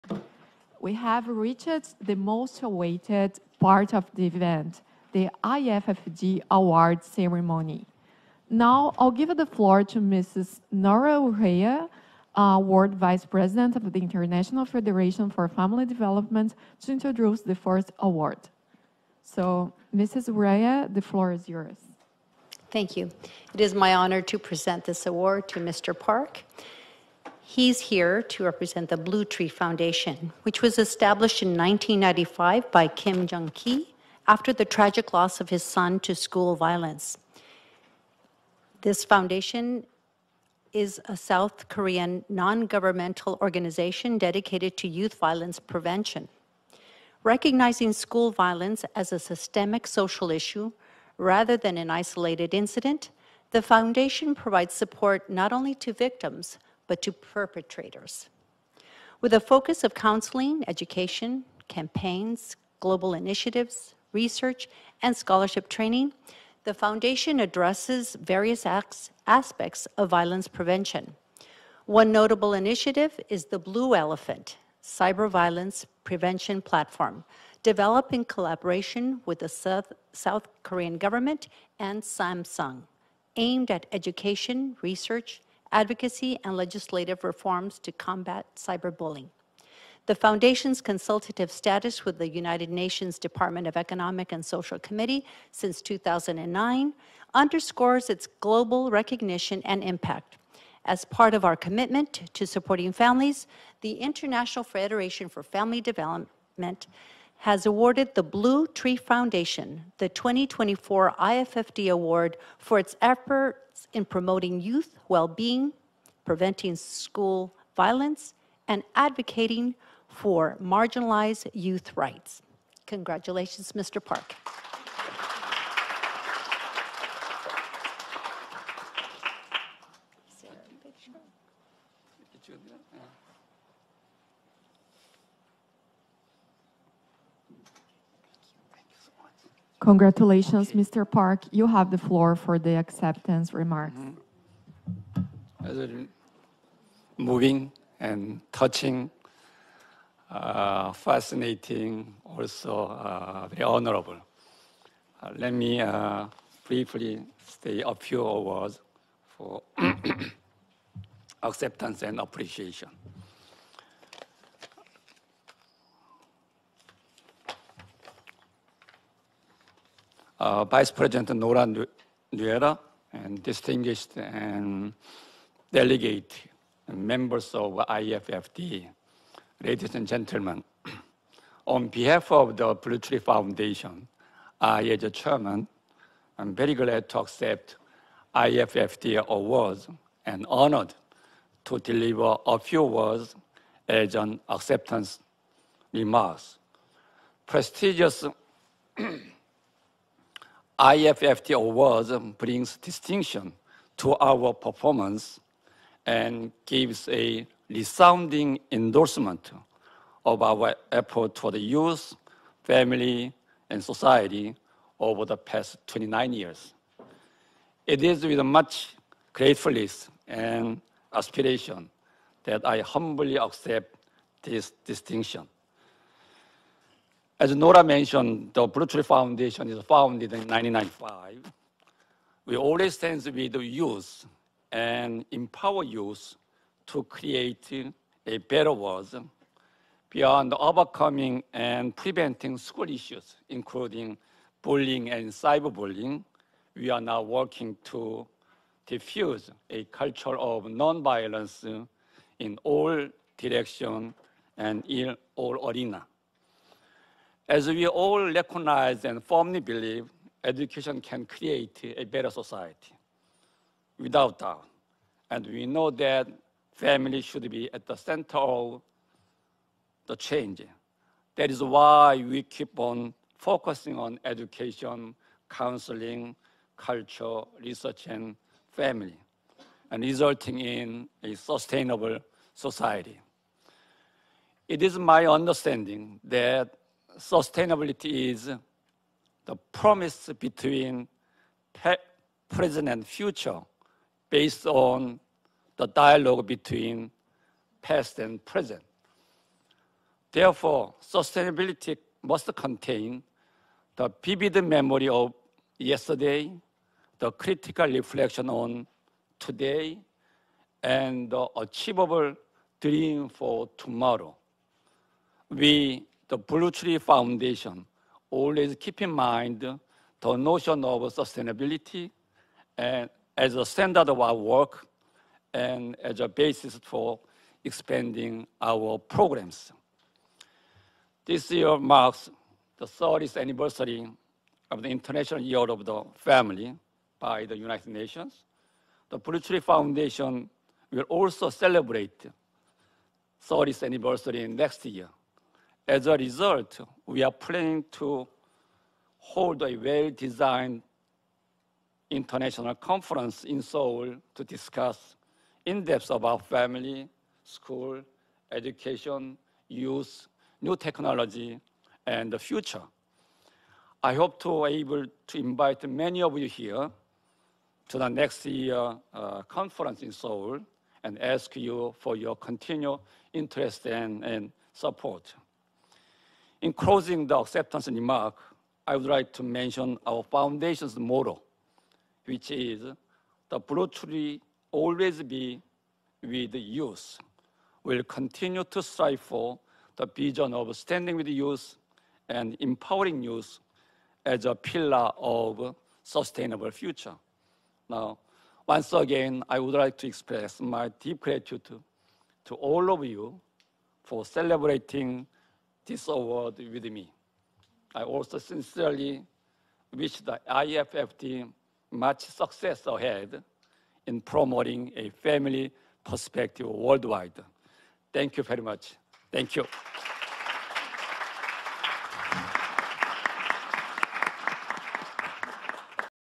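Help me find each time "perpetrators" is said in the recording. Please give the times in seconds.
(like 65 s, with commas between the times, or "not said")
57 s.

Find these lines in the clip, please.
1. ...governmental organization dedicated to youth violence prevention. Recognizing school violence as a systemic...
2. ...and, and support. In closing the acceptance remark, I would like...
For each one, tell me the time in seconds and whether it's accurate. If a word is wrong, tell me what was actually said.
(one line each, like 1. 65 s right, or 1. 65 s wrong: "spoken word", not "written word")
1. 42 s right
2. 373 s right.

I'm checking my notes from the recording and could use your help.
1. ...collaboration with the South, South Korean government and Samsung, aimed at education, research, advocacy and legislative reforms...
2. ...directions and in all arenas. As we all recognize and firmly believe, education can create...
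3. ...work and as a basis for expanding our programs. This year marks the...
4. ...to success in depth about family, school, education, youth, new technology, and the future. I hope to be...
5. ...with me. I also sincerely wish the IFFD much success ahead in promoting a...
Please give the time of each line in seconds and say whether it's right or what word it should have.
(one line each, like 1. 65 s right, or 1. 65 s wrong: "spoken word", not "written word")
1. 78 s right
2. 253 s right
3. 324 s right
4. 354 s wrong: "discuss", not "success"
5. 406 s right.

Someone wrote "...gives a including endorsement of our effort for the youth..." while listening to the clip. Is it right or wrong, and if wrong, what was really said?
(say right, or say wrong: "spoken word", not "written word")
wrong: "resounding", not "including".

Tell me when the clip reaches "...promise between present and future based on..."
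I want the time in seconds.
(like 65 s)
289 s.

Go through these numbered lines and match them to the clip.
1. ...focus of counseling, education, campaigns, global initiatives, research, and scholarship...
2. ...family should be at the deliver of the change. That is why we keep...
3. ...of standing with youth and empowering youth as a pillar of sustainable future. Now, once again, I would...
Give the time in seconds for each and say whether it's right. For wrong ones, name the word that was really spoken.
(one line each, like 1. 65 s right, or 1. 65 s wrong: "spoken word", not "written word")
1. 59 s right
2. 266 s wrong: "center", not "deliver"
3. 390 s right.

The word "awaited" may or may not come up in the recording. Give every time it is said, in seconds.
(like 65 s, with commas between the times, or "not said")
2 s.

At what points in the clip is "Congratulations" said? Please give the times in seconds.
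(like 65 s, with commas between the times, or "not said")
122 s, 139 s.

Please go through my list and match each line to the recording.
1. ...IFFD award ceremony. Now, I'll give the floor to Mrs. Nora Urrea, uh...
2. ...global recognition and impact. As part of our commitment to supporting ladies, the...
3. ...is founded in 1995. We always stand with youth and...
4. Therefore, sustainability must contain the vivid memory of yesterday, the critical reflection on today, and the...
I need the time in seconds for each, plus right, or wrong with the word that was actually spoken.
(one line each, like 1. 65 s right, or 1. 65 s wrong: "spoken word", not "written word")
1. 5 s right
2. 98 s wrong: "families", not "ladies"
3. 229 s right
4. 300 s right.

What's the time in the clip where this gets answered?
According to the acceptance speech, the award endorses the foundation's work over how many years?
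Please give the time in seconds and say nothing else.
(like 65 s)
215 s.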